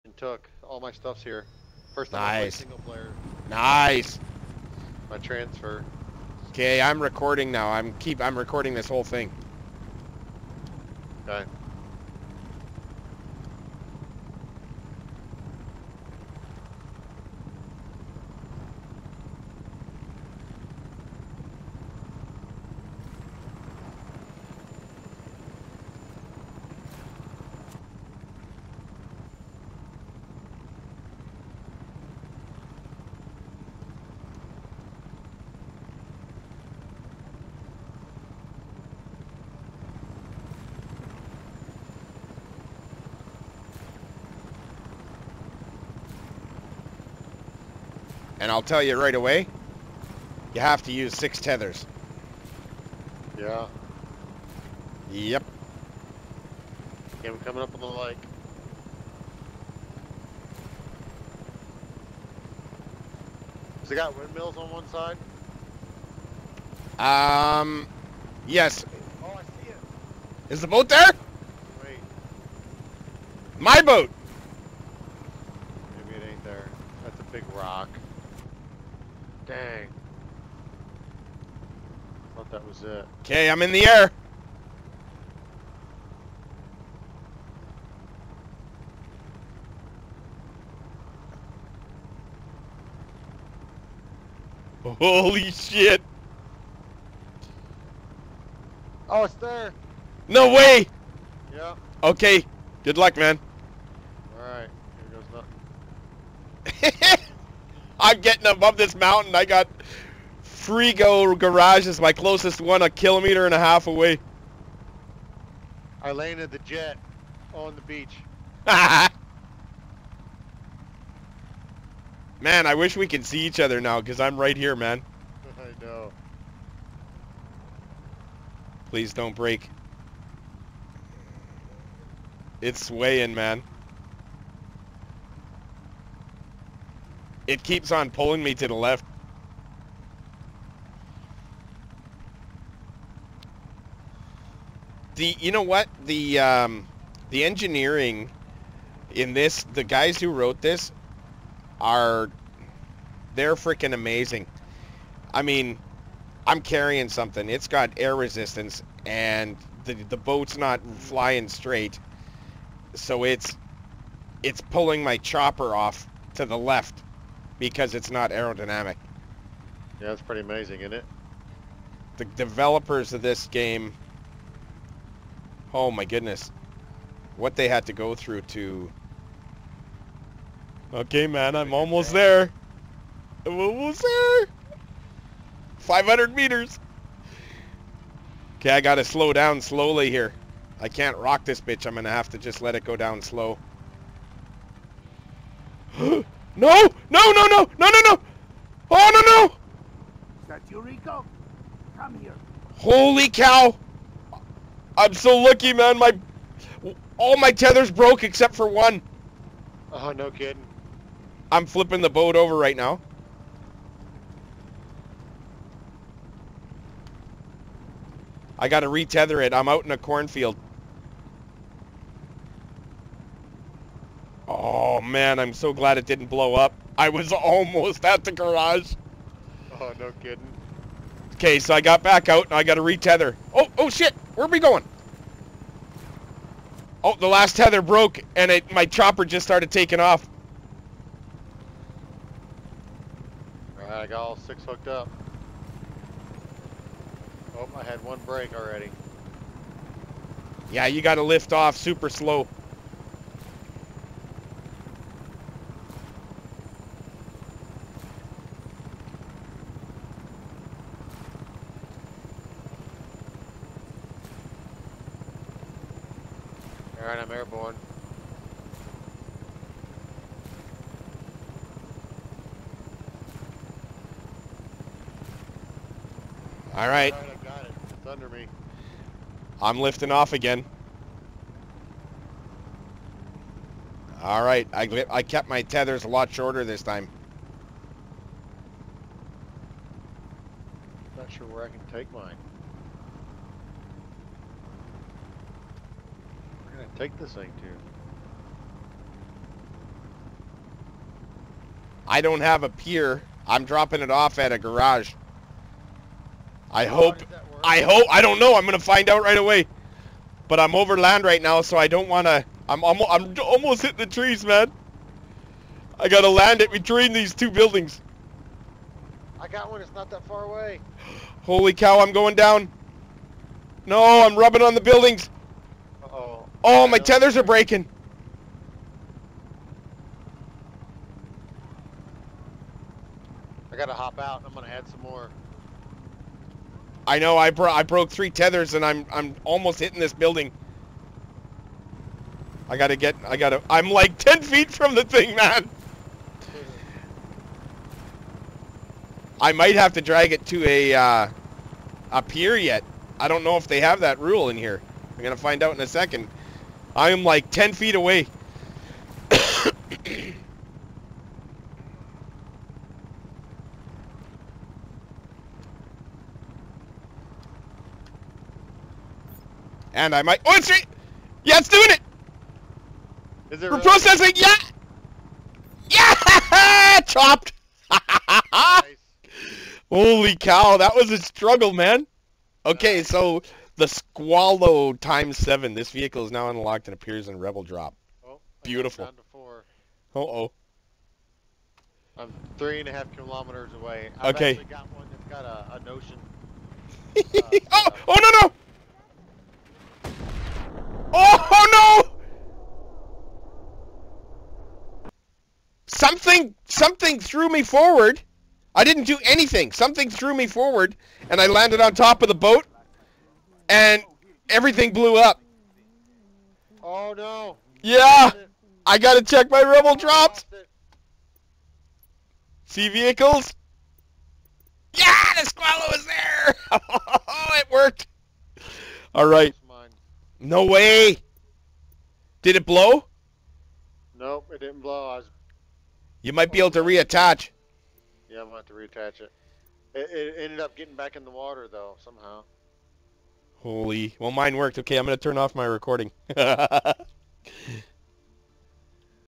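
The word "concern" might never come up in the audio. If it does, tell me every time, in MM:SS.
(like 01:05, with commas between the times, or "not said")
not said.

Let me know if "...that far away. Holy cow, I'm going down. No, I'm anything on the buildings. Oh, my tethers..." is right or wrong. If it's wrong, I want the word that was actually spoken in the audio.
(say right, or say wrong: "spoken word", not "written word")
wrong: "rubbing", not "anything".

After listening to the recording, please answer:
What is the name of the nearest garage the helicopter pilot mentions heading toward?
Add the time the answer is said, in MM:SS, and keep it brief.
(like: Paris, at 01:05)
Frigo Garage, at 01:50.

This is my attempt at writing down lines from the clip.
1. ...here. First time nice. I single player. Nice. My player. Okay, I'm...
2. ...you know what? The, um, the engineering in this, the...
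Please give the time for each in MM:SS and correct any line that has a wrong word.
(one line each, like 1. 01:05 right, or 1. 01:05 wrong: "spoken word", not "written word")
1. 00:01 wrong: "transfer", not "player"
2. 02:25 right.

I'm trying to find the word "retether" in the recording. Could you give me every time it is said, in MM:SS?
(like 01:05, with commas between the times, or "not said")
03:38, 03:52.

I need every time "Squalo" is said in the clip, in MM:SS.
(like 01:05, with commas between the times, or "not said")
06:23, 07:05.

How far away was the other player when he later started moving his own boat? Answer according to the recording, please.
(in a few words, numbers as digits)
3.5 kilometers.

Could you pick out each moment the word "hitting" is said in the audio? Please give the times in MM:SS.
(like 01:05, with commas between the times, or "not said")
05:13, 05:39.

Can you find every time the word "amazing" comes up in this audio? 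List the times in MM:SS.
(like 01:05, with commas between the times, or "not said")
02:33, 02:50.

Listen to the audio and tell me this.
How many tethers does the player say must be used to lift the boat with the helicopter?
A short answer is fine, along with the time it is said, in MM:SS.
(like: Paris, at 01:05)
6, at 00:51.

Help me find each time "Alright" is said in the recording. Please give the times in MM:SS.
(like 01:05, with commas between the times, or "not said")
01:44, 04:03, 04:27, 04:36, 04:44.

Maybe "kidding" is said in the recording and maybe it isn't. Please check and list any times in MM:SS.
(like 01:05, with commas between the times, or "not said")
03:30, 03:50.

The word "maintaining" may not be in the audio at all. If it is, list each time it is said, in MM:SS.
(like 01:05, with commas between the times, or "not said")
not said.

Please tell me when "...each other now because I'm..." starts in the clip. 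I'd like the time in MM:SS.
02:03.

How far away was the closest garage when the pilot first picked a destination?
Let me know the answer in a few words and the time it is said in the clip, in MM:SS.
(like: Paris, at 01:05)
1.5 kilometers, at 01:52.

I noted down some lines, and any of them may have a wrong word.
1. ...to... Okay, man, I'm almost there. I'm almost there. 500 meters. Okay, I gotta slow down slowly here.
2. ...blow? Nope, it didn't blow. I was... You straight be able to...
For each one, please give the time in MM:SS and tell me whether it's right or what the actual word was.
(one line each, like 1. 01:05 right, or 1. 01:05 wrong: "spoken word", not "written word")
1. 02:58 right
2. 07:12 wrong: "might", not "straight".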